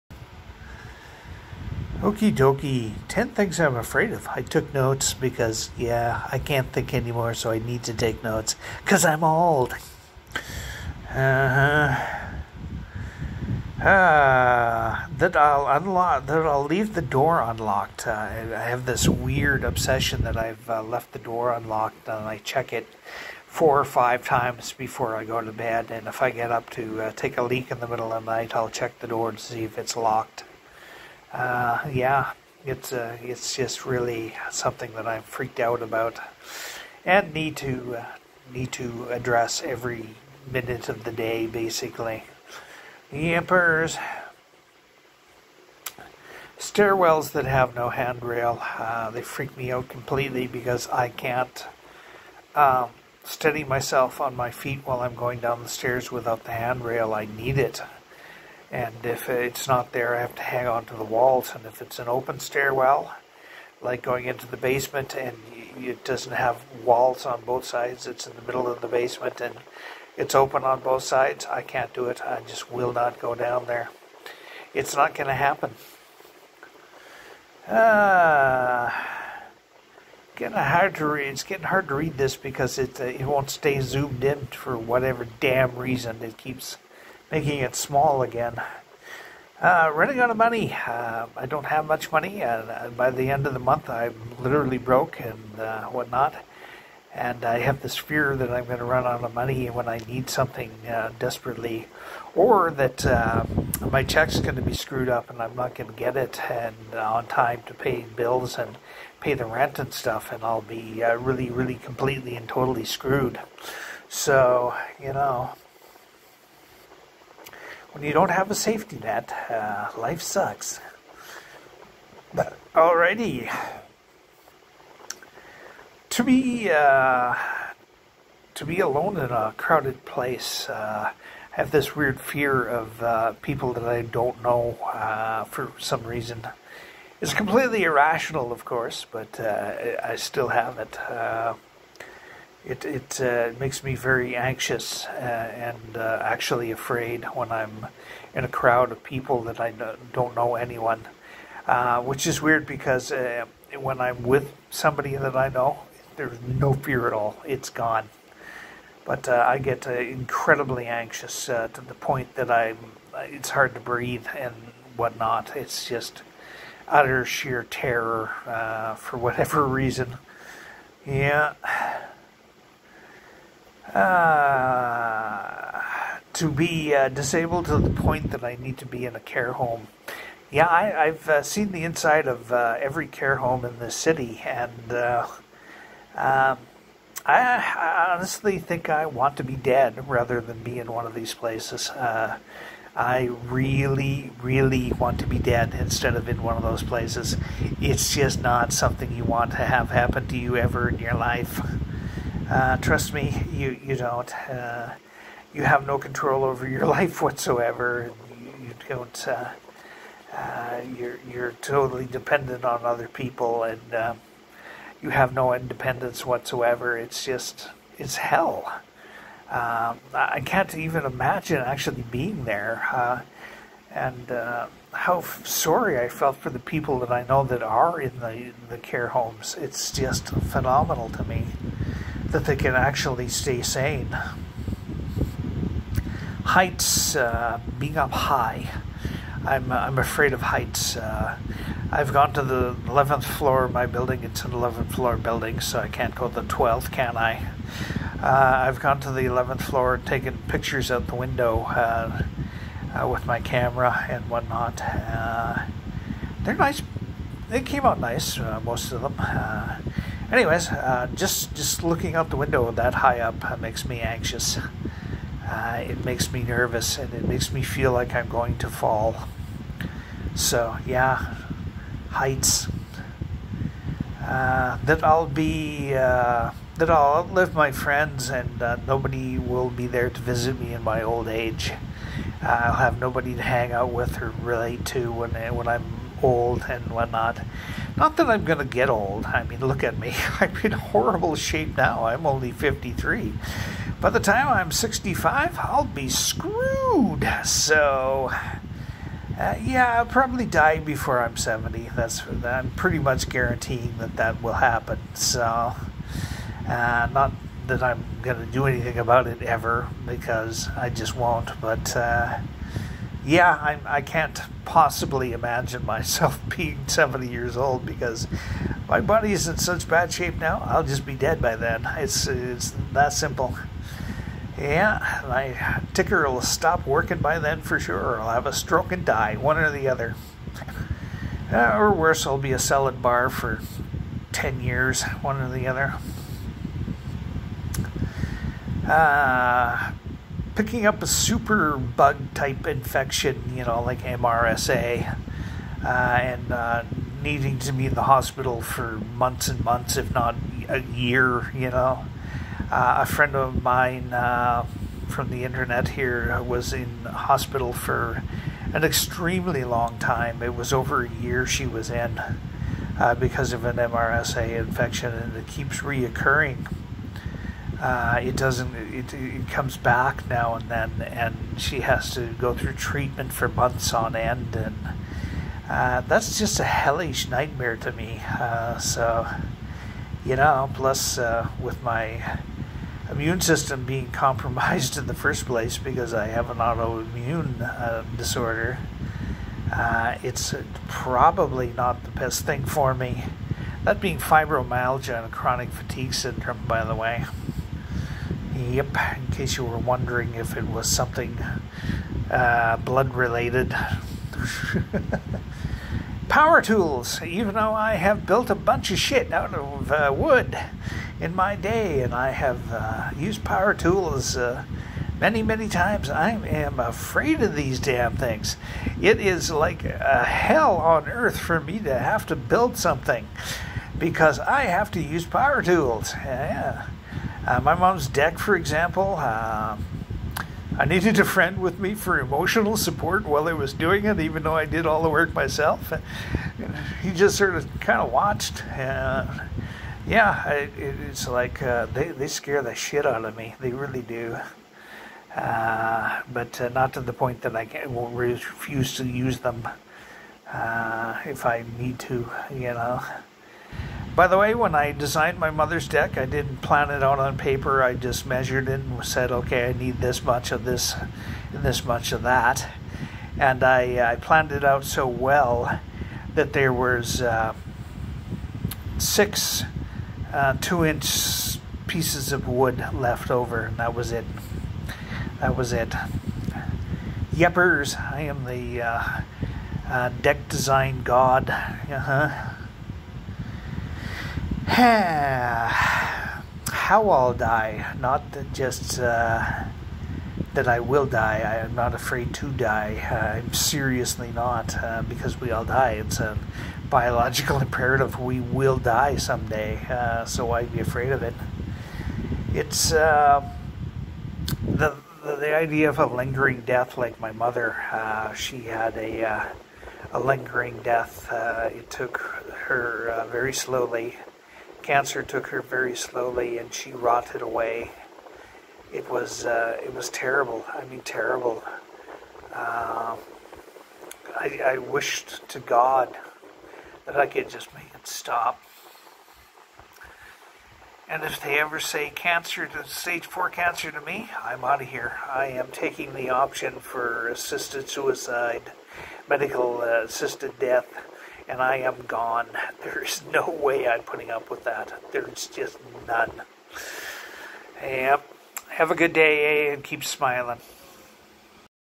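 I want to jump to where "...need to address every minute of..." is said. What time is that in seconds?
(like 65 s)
38 s.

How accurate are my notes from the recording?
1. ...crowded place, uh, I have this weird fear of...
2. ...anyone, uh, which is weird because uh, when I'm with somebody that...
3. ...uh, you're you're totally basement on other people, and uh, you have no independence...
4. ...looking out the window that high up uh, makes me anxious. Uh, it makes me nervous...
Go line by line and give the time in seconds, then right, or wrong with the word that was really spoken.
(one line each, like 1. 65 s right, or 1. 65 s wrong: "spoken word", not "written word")
1. 129 s right
2. 150 s right
3. 210 s wrong: "dependent", not "basement"
4. 261 s right.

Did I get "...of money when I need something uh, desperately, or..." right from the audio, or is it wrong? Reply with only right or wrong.
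right.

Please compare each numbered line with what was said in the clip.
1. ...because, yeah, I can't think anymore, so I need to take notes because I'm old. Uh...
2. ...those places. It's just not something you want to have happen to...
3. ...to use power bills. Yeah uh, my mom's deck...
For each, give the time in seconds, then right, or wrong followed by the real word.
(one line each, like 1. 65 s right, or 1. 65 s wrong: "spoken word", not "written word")
1. 5 s right
2. 196 s right
3. 424 s wrong: "tools", not "bills".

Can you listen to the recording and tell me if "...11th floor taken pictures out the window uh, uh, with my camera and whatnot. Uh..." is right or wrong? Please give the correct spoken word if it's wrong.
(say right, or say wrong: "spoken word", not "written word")
right.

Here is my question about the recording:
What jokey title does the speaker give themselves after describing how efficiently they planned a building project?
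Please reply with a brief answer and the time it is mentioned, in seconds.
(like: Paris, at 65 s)
Deck design god, at 480 s.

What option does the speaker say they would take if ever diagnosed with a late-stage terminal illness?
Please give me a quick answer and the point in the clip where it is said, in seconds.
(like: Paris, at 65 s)
Assisted suicide, at 537 s.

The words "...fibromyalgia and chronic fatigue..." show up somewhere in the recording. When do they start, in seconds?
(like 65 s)
394 s.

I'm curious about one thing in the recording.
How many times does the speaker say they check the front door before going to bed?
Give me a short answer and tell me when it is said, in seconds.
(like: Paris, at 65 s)
4 or 5, at 23 s.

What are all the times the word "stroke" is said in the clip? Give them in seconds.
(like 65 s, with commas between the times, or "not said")
328 s.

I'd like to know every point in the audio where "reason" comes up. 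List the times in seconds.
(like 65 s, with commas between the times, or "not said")
85 s, 136 s, 169 s.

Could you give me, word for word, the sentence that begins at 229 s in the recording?
It's just phenomenal to me that they can actually stay sane.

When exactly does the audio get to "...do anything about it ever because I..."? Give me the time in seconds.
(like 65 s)
308 s.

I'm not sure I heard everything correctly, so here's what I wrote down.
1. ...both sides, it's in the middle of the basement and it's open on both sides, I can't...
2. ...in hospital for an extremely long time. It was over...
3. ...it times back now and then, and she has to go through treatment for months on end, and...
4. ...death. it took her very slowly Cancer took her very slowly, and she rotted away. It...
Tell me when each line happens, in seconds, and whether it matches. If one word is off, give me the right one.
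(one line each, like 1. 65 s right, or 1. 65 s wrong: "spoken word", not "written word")
1. 67 s right
2. 356 s right
3. 369 s wrong: "comes", not "times"
4. 510 s right.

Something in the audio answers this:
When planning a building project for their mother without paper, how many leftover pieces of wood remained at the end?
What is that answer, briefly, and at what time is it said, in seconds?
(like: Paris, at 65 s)
6, at 468 s.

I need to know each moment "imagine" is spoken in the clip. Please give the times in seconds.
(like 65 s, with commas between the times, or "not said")
221 s, 315 s.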